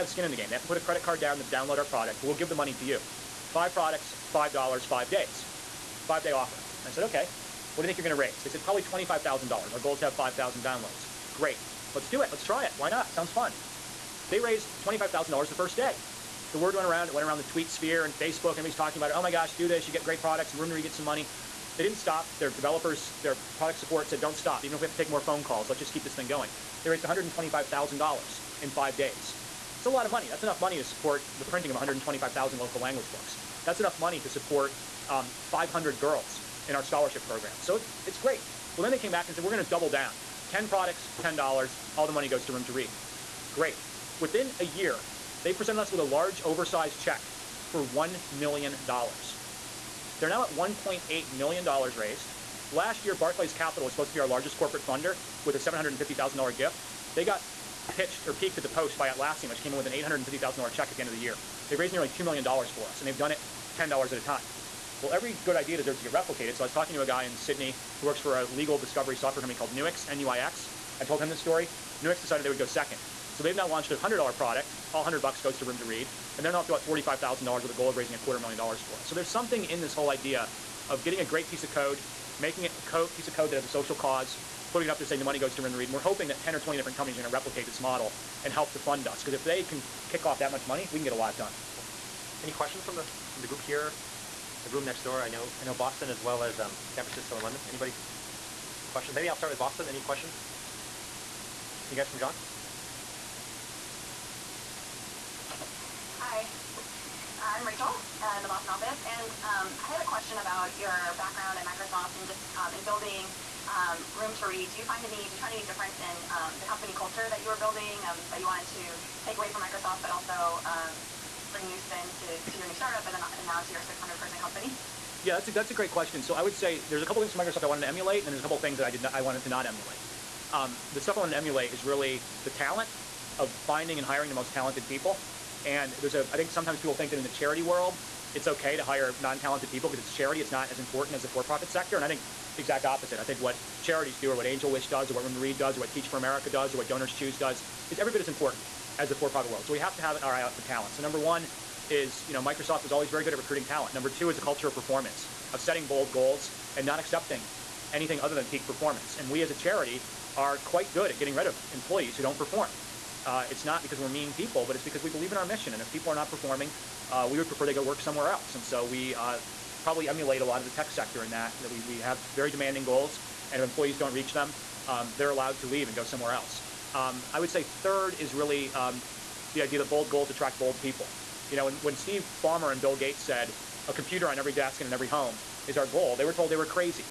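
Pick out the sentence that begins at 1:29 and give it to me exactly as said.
Because if they can kick off that much money, we can get a lot done.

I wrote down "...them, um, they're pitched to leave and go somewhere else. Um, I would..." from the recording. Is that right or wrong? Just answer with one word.
wrong.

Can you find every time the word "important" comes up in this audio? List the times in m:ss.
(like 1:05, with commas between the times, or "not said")
2:20, 2:28.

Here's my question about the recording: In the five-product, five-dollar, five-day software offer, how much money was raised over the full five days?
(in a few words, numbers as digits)
$125,000.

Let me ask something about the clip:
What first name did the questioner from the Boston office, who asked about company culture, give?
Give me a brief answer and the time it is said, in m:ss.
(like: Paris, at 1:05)
Rachel, at 1:47.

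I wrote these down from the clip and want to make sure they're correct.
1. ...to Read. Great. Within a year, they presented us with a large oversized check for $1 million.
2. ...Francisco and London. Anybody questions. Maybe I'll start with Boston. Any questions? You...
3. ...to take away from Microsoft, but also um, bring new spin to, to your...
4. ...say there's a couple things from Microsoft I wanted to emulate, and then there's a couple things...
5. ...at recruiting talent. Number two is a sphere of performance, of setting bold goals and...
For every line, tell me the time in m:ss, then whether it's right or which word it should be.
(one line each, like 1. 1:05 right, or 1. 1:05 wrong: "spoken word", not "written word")
1. 0:42 right
2. 1:37 right
3. 1:58 right
4. 2:06 right
5. 2:33 wrong: "culture", not "sphere".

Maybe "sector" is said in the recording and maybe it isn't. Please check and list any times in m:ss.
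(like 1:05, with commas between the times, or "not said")
2:21, 2:50.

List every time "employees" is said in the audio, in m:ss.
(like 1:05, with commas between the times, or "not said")
2:41, 2:53.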